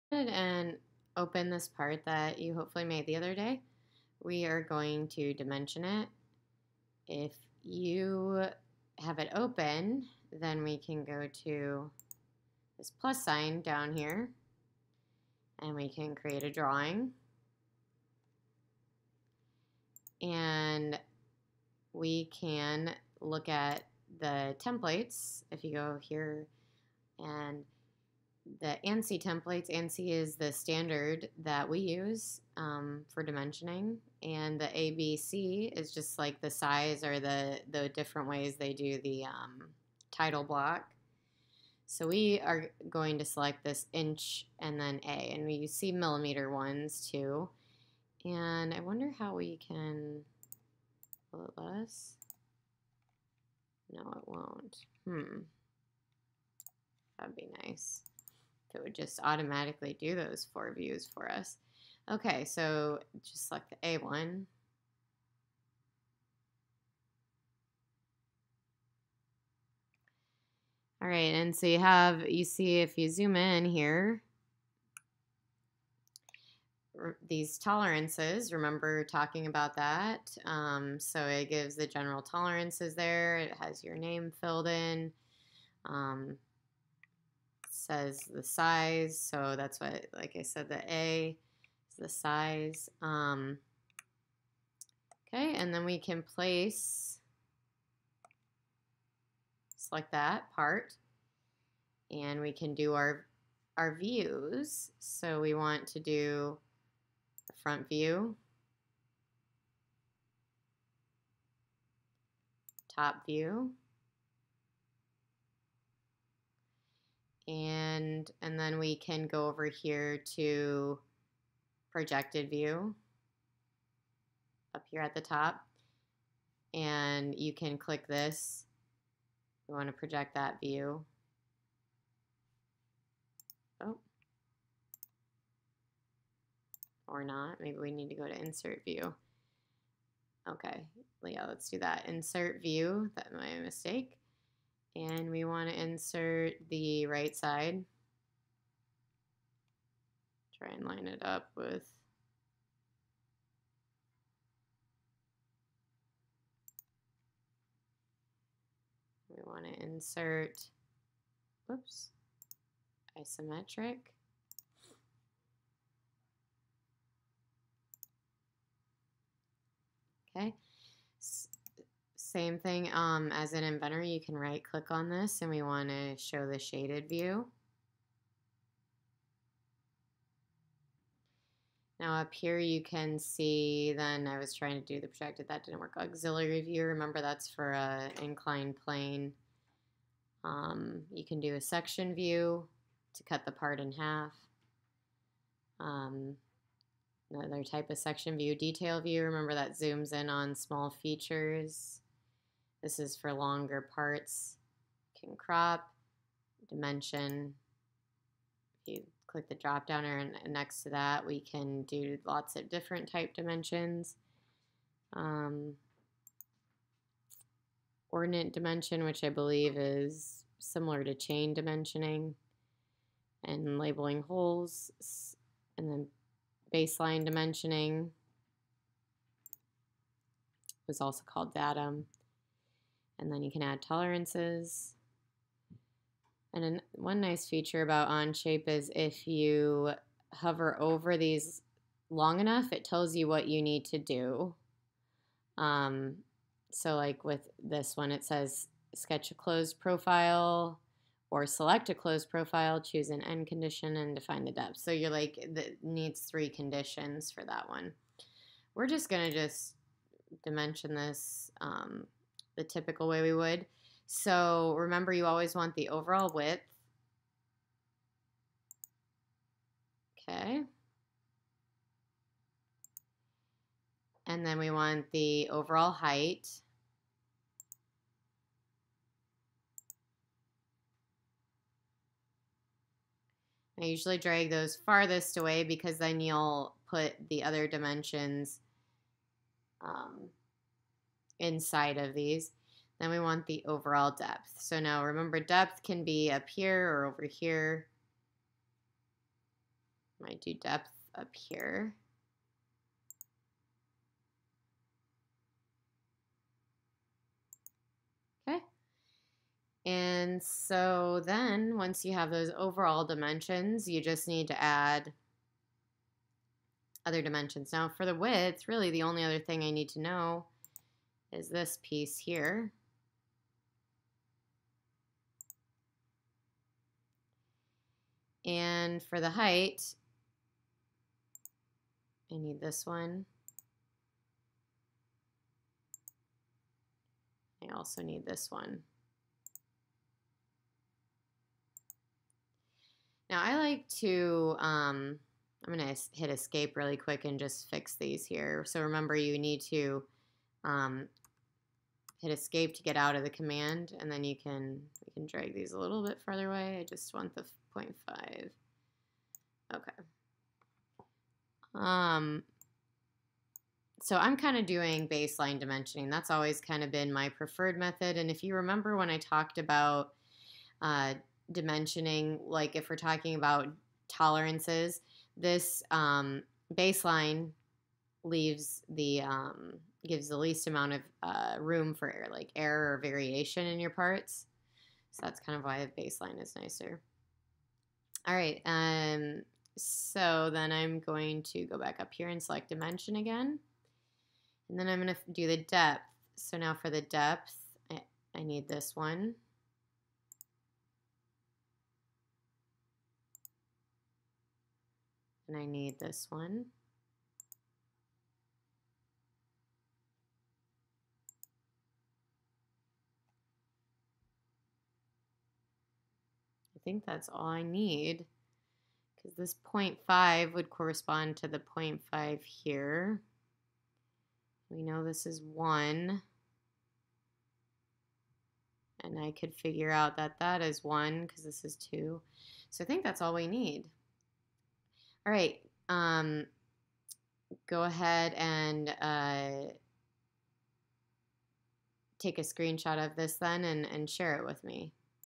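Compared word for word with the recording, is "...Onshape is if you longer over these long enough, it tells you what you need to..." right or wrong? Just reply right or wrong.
wrong.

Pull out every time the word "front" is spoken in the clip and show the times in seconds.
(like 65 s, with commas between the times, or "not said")
107 s.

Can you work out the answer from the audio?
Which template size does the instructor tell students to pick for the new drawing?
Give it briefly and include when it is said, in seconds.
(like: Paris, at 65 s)
A1, at 63 s.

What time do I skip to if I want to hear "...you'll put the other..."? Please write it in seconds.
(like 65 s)
286 s.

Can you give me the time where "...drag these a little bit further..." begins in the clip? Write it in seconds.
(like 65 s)
355 s.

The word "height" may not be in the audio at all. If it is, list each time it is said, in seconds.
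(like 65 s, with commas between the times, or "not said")
275 s, 329 s.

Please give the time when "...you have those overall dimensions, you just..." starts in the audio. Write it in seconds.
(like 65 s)
312 s.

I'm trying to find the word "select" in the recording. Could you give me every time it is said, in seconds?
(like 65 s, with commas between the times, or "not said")
43 s, 63 s, 99 s, 251 s, 392 s.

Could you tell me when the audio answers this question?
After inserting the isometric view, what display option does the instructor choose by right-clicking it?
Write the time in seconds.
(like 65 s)
176 s.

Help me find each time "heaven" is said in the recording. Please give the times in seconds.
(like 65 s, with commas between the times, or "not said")
not said.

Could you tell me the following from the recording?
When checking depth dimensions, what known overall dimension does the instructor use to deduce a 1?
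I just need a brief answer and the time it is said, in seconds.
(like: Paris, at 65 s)
2, at 431 s.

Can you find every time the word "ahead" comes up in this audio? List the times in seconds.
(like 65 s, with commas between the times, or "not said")
0 s, 437 s.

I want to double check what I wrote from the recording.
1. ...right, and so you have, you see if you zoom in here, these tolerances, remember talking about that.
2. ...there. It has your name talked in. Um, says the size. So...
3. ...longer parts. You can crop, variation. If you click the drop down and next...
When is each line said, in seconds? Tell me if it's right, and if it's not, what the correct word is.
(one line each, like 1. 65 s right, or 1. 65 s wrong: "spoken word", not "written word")
1. 71 s right
2. 82 s wrong: "filled", not "talked"
3. 203 s wrong: "dimension", not "variation".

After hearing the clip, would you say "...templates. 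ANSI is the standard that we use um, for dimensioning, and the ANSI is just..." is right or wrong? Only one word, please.
wrong.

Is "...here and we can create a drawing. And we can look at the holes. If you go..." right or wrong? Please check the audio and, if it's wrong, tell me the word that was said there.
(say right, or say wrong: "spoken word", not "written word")
wrong: "templates", not "holes".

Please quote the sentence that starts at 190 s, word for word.
Um, you can do a section view to cut the part in half.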